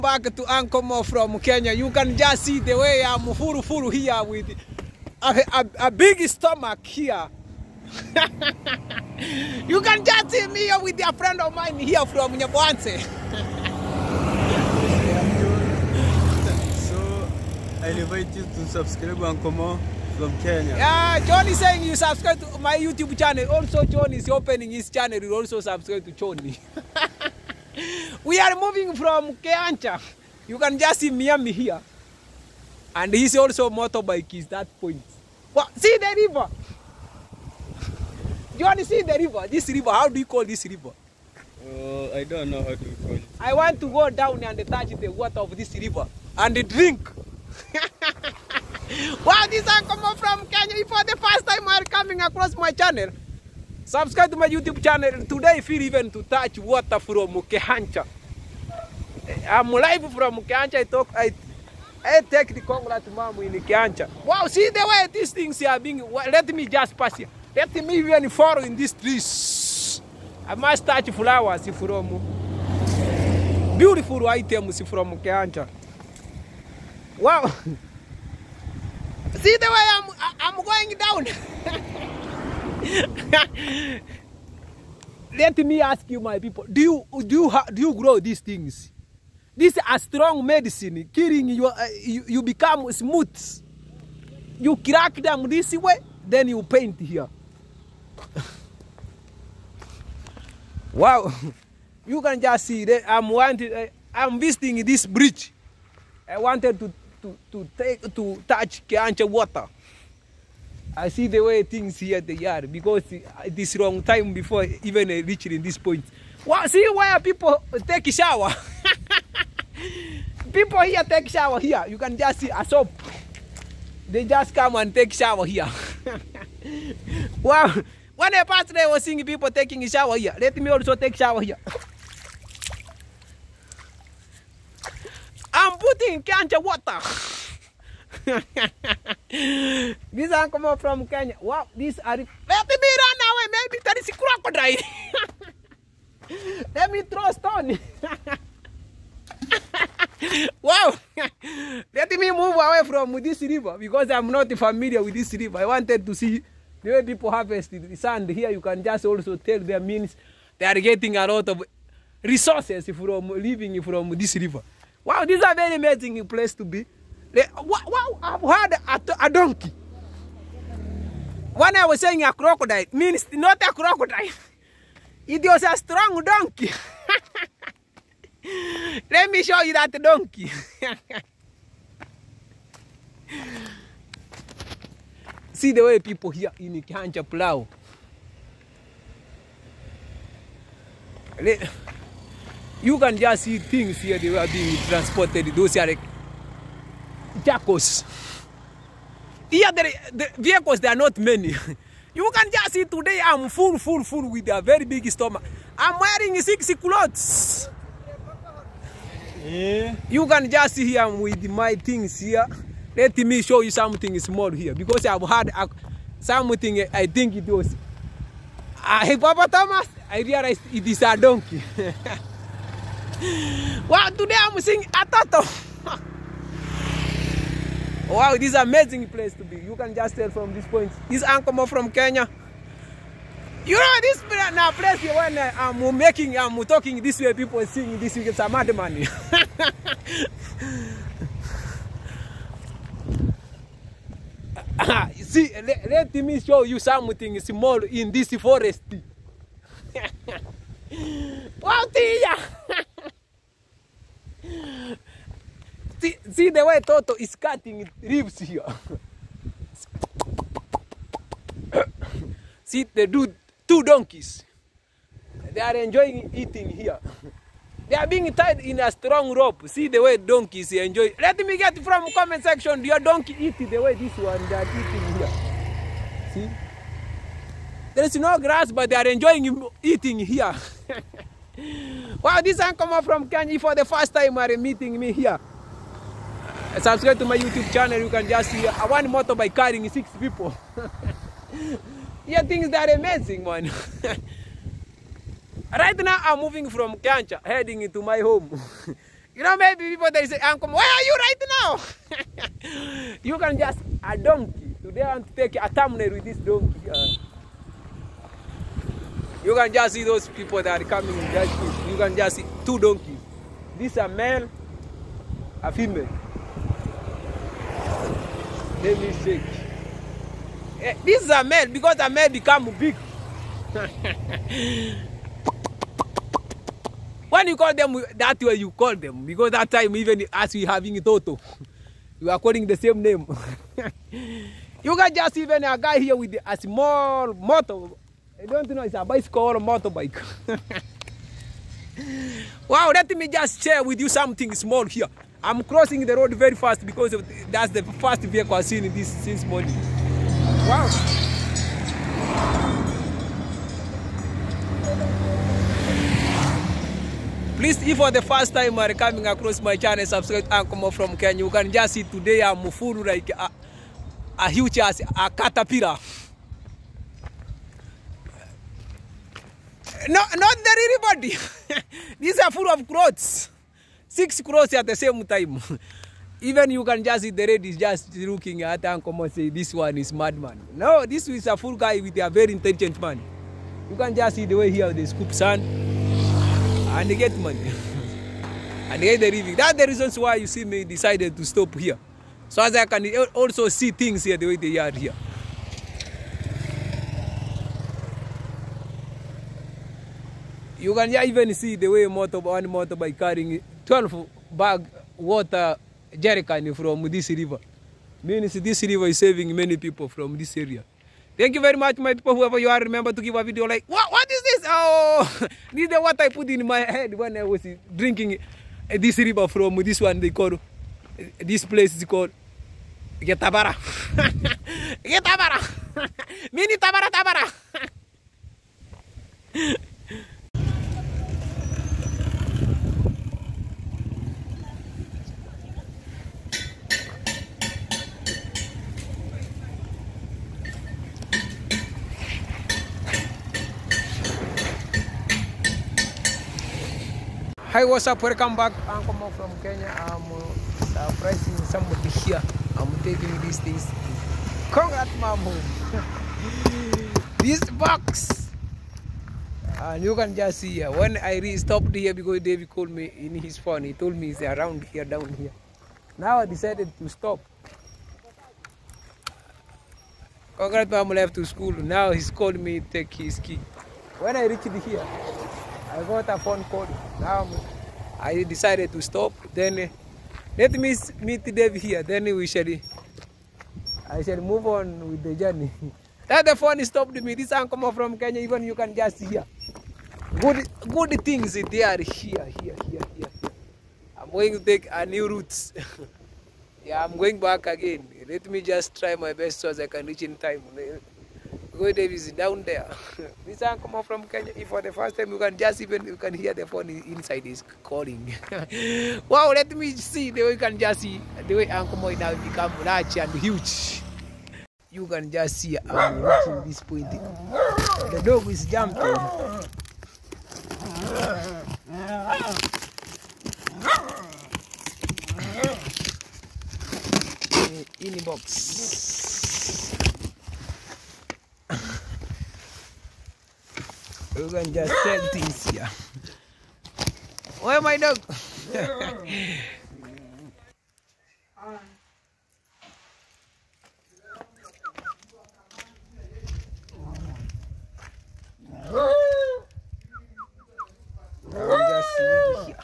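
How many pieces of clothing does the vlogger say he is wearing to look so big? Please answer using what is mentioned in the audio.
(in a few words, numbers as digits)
6.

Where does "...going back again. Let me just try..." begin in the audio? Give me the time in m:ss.
8:17.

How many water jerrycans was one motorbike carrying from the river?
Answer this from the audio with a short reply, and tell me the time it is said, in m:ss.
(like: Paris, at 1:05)
12, at 6:43.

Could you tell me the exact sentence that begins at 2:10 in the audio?
Let me also take shower here.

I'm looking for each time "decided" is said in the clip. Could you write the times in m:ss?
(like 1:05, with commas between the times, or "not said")
6:30, 7:46, 7:58.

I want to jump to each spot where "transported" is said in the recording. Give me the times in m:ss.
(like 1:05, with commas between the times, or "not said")
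3:14.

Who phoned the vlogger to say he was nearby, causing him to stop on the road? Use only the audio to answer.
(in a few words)
David.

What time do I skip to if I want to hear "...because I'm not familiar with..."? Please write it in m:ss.
2:33.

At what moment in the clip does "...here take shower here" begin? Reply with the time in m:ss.
2:00.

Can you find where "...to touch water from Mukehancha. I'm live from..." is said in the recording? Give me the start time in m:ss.
0:56.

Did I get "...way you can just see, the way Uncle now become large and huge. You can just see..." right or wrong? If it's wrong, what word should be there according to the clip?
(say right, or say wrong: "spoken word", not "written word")
right.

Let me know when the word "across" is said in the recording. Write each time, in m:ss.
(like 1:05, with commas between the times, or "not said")
0:52, 5:59.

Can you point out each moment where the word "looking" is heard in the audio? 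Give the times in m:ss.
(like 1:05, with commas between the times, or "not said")
6:18.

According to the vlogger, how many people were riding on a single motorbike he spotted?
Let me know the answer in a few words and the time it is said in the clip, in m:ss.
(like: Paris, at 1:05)
6, at 4:49.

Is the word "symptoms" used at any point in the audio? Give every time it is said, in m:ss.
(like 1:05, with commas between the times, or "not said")
not said.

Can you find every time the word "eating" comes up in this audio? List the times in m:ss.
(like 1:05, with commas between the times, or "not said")
4:26, 4:34, 4:39.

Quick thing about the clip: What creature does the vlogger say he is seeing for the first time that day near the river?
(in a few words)
A turtle.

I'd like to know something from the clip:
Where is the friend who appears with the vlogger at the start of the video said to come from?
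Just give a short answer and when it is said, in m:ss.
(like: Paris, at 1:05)
Nyabwanse, at 0:12.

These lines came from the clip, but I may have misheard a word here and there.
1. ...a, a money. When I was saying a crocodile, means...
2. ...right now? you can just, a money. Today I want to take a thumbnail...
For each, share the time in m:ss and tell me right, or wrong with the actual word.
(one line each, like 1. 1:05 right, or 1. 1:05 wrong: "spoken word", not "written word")
1. 2:48 wrong: "donkey", not "money"
2. 5:01 wrong: "donkey", not "money".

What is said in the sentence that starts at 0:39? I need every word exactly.
This river, how do you call this river?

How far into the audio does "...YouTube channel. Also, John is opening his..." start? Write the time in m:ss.
0:22.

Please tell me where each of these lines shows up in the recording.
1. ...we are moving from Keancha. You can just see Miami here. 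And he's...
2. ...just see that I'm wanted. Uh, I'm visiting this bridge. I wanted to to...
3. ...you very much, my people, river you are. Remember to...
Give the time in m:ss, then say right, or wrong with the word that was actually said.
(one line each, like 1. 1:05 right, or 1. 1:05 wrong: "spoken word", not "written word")
1. 0:28 right
2. 1:42 right
3. 6:51 wrong: "whoever", not "river".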